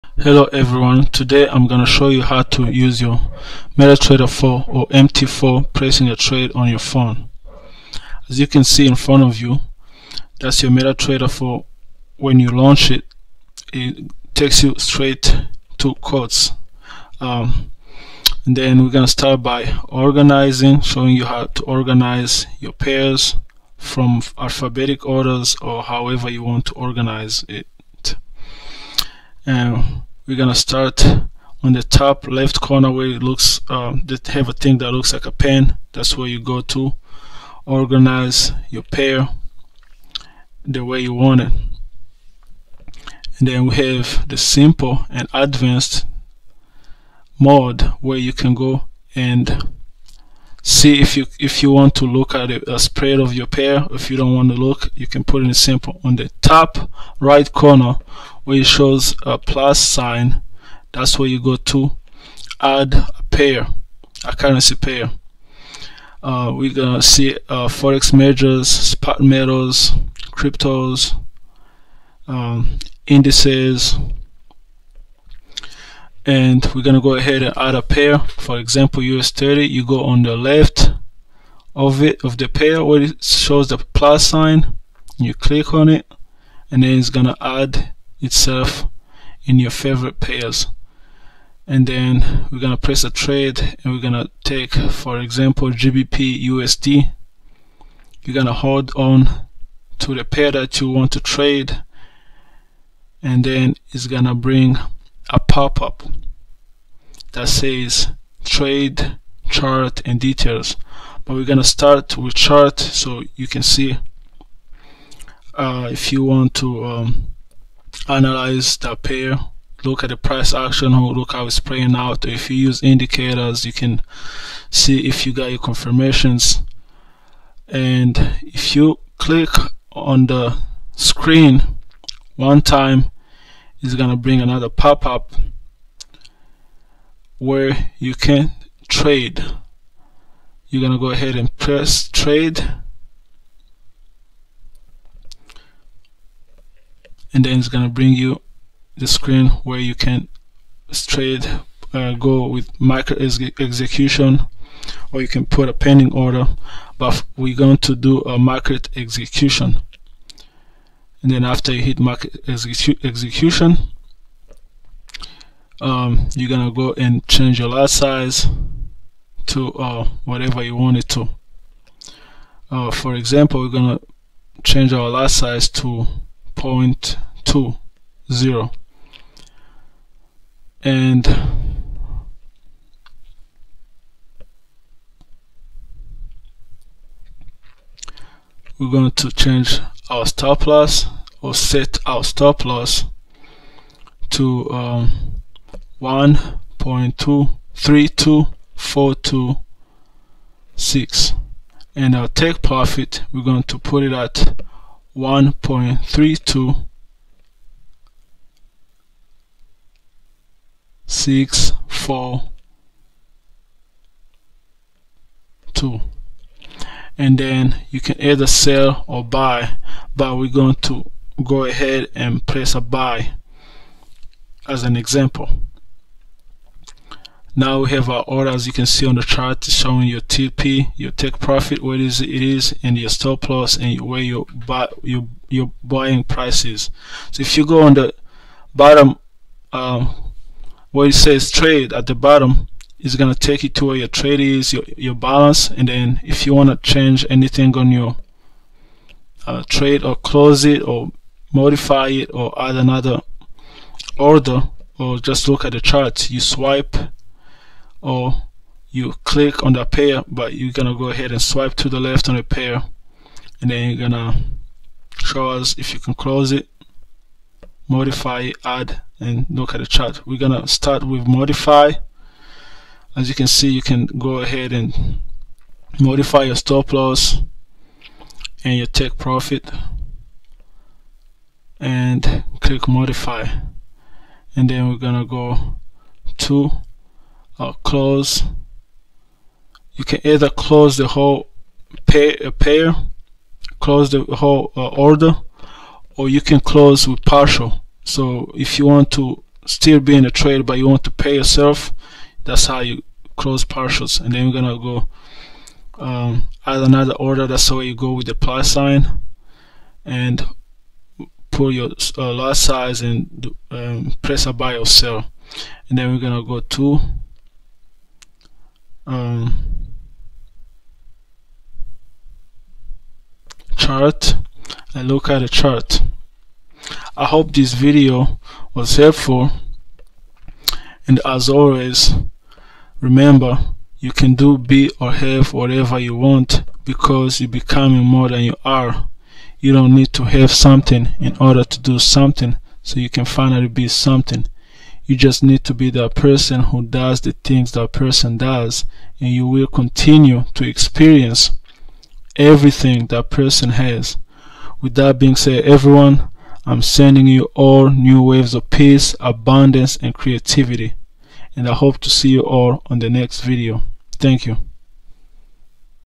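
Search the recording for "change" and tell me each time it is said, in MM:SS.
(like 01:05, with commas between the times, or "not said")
02:47, 02:54, 03:09, 04:06.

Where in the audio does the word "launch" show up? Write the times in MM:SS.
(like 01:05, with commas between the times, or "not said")
00:12.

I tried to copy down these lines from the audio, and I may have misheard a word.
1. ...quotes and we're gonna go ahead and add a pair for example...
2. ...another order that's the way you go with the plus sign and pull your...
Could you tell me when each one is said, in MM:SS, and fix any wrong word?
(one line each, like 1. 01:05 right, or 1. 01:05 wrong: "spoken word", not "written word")
1. 01:13 wrong: "indices", not "quotes"
2. 05:06 right.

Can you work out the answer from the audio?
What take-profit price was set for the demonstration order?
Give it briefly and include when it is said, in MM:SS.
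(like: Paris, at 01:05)
1.32642, at 03:25.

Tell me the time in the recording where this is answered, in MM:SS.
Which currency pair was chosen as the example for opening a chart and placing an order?
01:35.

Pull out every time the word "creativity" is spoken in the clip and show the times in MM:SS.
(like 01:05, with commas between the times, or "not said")
06:00.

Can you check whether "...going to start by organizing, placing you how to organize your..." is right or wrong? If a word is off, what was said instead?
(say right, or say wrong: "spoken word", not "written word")
wrong: "showing", not "placing".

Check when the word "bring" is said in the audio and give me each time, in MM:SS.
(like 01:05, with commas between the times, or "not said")
01:44, 02:14, 02:27.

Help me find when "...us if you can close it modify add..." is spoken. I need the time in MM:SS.
04:25.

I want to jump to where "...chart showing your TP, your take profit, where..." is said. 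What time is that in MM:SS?
03:49.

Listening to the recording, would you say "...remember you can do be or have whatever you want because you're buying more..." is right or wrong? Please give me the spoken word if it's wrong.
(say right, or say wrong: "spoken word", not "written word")
wrong: "becoming", not "buying".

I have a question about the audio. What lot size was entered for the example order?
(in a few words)
0.20.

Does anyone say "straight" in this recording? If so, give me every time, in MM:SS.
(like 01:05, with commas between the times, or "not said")
00:14, 02:30.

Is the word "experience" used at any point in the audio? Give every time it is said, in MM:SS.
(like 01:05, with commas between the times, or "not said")
05:50.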